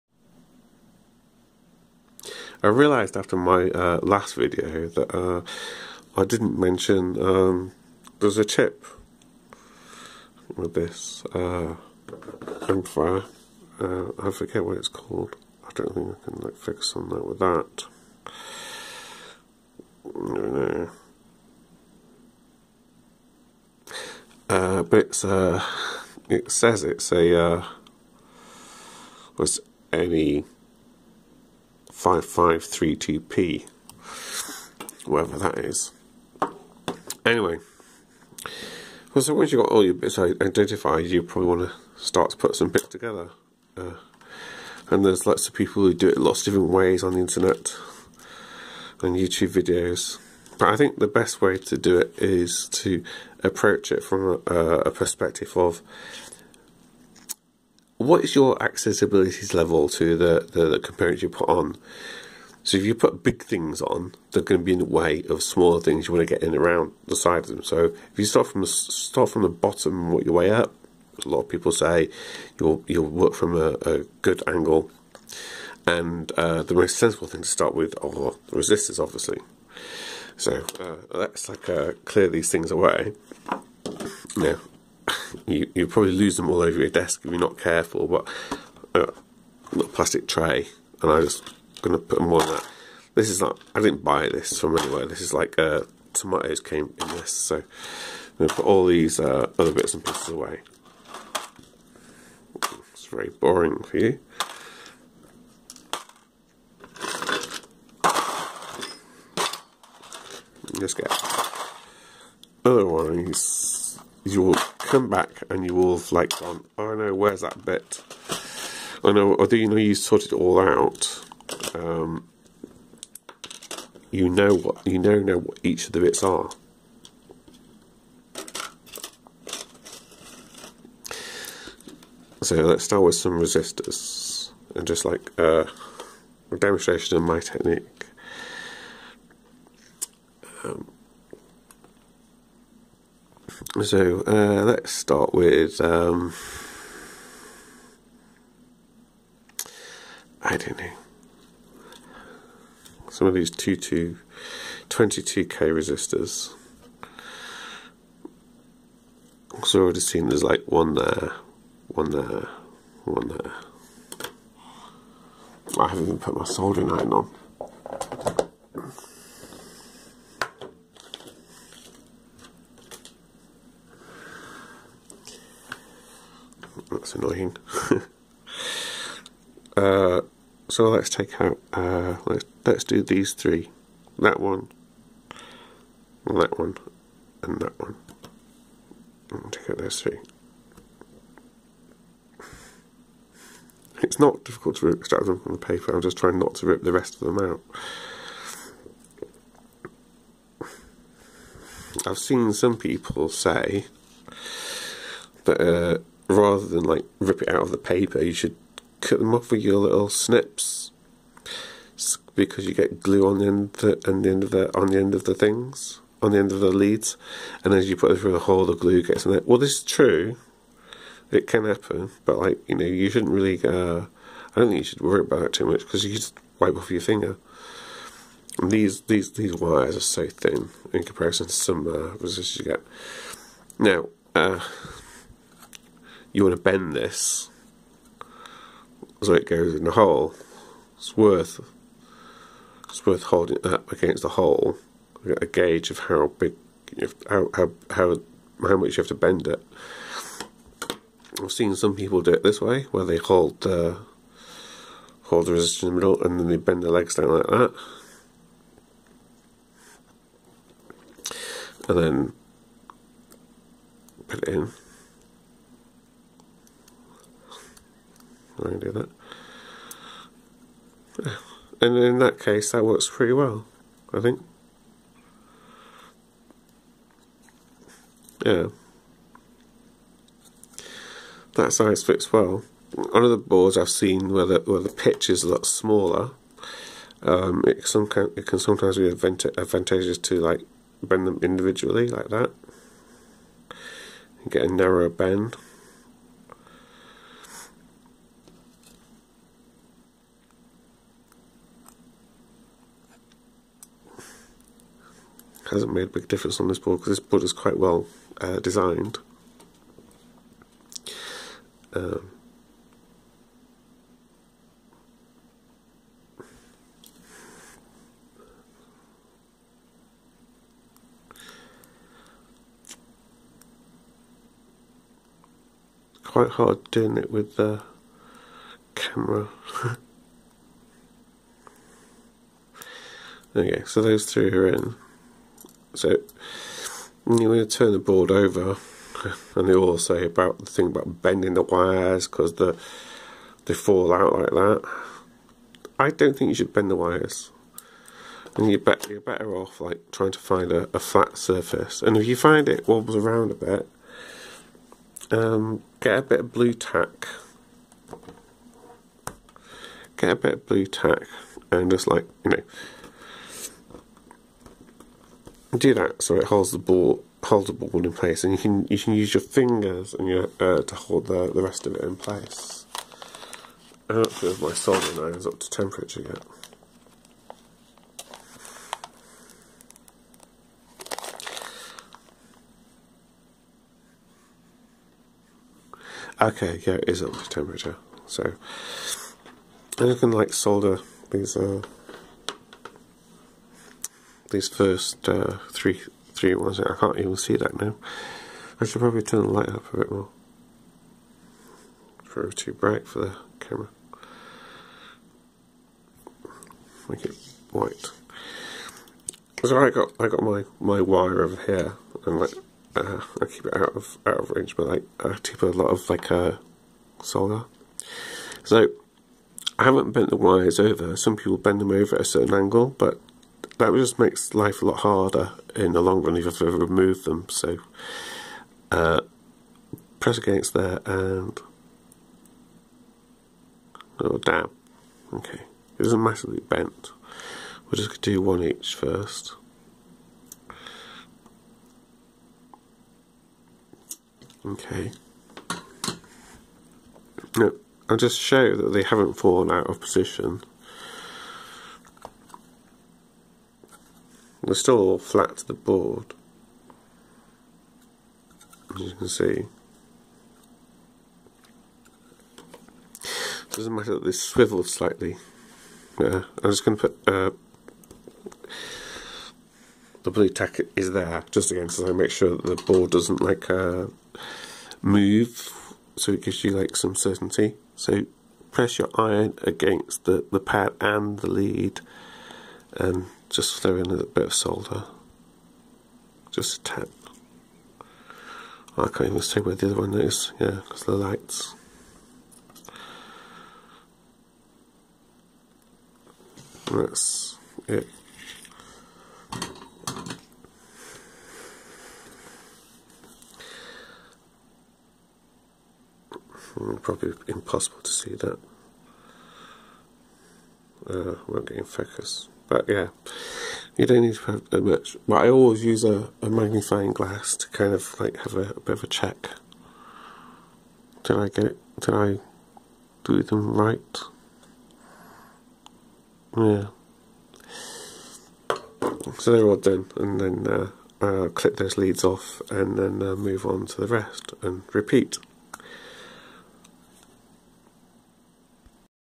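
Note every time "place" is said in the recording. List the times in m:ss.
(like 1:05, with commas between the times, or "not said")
6:08, 6:12.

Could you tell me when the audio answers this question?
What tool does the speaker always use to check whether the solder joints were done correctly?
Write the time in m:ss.
8:36.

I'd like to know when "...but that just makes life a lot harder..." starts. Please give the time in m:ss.
7:02.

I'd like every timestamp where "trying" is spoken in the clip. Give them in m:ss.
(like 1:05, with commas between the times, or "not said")
3:16, 5:50.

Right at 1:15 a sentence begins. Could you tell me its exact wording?
And uh, the most sensible thing to start with are the resistors, obviously.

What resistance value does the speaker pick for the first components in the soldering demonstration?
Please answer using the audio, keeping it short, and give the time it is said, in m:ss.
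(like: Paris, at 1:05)
22k, at 2:33.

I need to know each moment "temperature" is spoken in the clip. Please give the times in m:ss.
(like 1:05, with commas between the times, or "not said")
6:15, 6:27.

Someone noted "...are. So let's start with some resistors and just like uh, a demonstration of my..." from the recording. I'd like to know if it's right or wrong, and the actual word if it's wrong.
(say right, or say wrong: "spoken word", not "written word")
right.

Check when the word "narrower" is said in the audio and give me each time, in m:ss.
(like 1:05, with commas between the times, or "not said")
4:54.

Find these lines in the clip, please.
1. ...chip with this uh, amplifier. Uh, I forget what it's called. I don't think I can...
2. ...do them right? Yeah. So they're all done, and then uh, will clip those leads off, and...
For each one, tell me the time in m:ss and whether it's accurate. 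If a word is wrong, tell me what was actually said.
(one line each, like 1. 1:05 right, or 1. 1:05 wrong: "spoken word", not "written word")
1. 0:08 right
2. 8:43 right.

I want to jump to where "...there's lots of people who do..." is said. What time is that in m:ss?
0:45.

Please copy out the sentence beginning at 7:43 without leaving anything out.
It doesn't matter that this swivels slightly.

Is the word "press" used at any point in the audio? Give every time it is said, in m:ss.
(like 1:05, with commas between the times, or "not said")
7:10, 7:58.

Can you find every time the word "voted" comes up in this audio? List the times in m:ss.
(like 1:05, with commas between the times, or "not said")
not said.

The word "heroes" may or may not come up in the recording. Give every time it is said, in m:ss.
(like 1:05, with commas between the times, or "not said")
not said.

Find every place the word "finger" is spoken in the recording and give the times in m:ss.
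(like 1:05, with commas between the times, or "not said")
3:47, 6:09.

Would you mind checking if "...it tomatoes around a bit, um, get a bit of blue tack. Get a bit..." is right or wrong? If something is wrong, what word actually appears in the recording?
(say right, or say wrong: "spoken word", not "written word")
wrong: "wobbles", not "tomatoes".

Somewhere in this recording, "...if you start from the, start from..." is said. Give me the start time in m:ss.
1:08.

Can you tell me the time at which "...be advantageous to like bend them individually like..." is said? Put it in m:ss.
4:48.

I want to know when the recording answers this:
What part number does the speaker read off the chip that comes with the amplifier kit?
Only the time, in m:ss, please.
0:32.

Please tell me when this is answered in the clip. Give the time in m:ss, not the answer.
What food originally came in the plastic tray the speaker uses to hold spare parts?
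1:36.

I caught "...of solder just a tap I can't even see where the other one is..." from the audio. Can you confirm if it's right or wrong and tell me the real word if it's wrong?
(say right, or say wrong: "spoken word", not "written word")
right.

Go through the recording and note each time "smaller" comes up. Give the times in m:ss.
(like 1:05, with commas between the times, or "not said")
1:05, 4:45.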